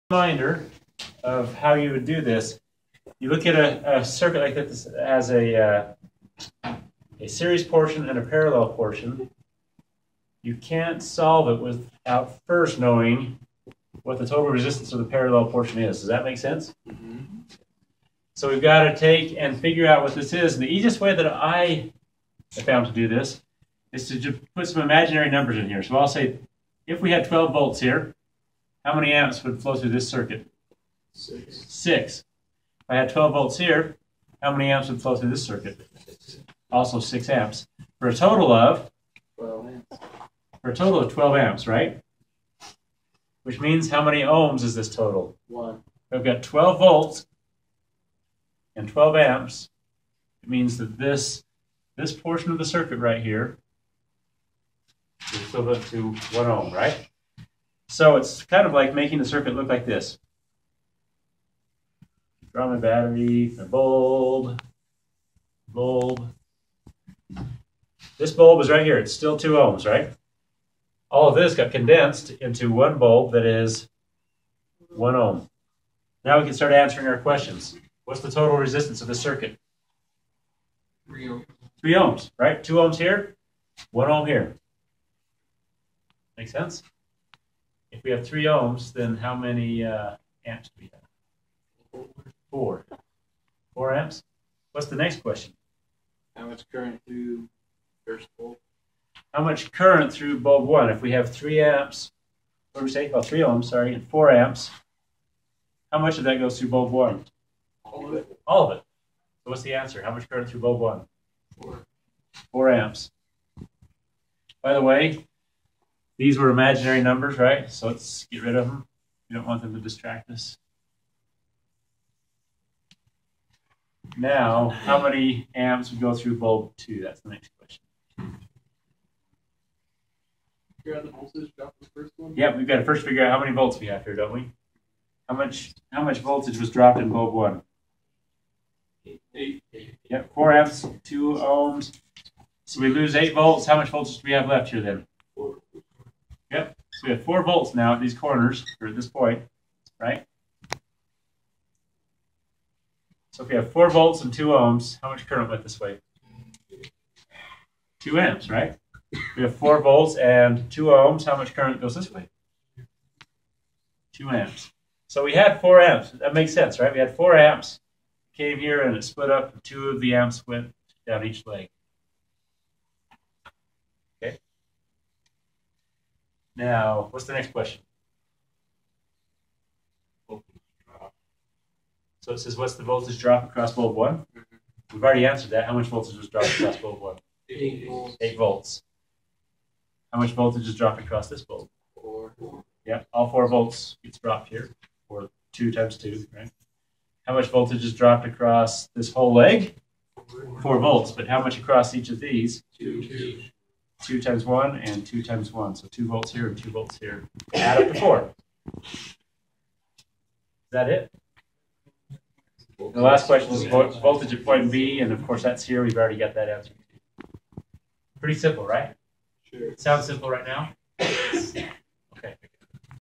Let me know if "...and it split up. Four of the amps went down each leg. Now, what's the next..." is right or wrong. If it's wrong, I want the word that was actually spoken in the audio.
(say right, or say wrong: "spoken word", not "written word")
wrong: "Two", not "Four".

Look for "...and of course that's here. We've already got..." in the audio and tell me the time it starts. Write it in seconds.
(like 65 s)
215 s.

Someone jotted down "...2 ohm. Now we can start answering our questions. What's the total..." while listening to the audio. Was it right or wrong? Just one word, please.
wrong.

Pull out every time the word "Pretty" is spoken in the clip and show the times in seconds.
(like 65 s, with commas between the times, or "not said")
218 s.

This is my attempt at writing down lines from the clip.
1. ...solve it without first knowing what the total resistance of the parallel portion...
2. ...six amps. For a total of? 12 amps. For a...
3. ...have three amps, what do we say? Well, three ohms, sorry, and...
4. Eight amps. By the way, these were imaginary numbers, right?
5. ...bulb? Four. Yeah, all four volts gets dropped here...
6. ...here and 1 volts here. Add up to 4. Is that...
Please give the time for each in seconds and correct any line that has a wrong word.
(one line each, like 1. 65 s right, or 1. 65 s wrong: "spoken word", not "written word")
1. 11 s right
2. 36 s right
3. 101 s right
4. 112 s wrong: "Four", not "Eight"
5. 191 s right
6. 206 s wrong: "2", not "1".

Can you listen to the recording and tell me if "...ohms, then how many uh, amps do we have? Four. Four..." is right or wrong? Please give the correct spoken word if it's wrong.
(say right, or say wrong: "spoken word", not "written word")
right.